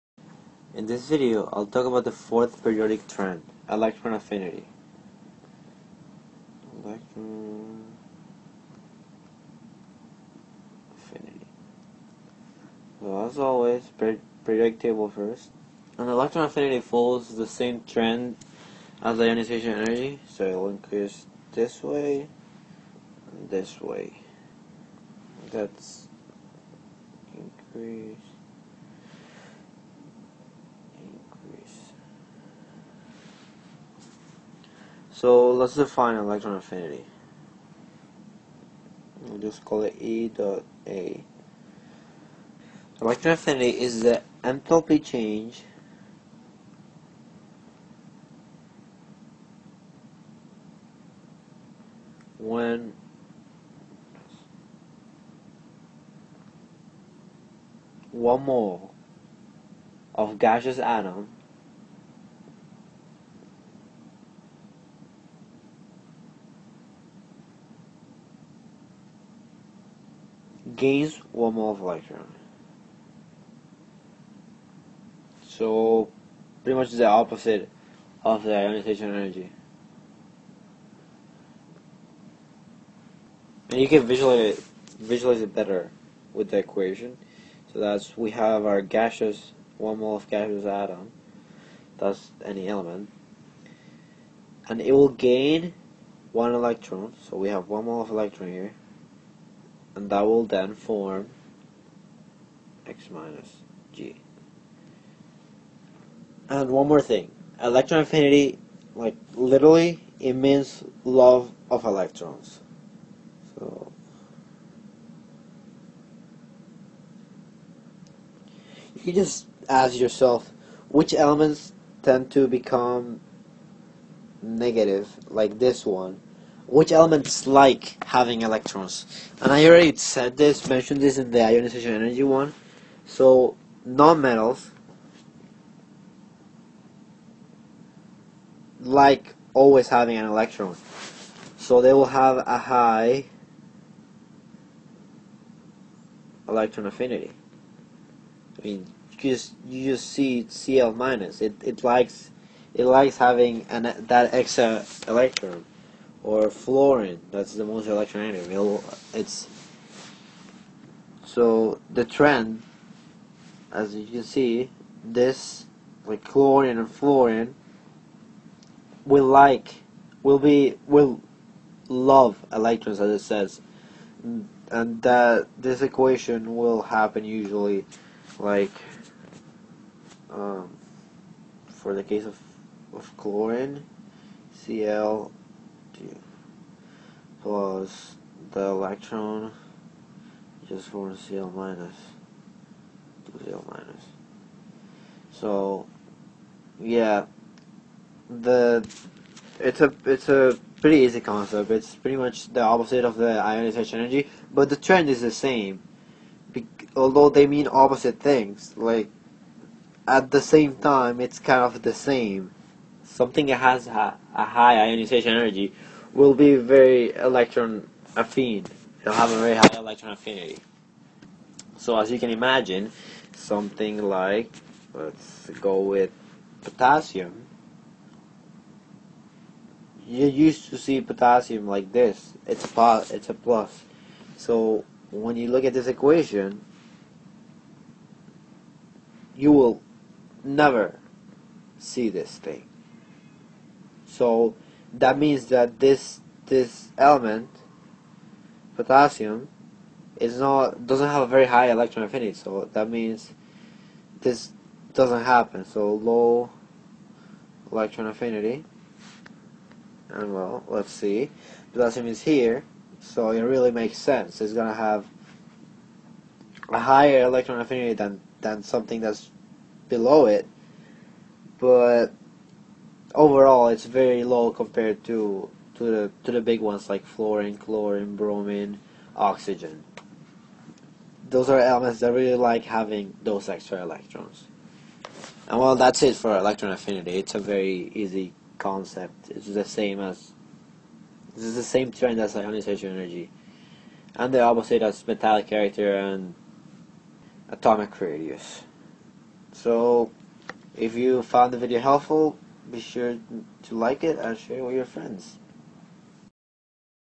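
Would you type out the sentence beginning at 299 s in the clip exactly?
So, if you found the video helpful, be sure to like it and uh, share it with your friends.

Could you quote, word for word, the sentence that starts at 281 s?
Those are elements that really like having those extra electrons.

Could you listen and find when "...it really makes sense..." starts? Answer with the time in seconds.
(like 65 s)
263 s.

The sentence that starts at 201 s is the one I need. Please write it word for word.
It's pretty much the opposite of the ionization energy, but the trend is the same.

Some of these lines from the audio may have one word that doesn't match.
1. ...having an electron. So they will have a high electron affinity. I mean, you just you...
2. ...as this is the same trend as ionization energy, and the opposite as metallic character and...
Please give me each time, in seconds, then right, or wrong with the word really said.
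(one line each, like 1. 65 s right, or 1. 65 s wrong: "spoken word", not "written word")
1. 139 s right
2. 289 s right.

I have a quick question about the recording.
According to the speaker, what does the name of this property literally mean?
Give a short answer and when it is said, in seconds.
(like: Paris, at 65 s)
Love of electrons, at 111 s.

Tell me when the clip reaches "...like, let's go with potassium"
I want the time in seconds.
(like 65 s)
224 s.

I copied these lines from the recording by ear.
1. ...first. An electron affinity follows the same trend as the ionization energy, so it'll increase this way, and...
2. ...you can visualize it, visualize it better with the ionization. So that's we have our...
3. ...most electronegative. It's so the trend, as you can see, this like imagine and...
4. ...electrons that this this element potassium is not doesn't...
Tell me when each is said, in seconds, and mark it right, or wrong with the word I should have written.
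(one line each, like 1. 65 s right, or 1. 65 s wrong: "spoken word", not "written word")
1. 15 s right
2. 83 s wrong: "equation", not "ionization"
3. 157 s wrong: "chlorine", not "imagine"
4. 245 s wrong: "means", not "electrons".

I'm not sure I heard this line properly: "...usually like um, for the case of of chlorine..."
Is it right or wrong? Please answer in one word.
right.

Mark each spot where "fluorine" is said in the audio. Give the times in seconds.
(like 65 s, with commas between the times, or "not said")
156 s, 166 s, 277 s.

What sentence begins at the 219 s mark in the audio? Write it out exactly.
It'll have a very high electron affinity.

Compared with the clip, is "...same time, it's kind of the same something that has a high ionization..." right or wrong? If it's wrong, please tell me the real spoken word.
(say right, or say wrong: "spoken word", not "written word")
right.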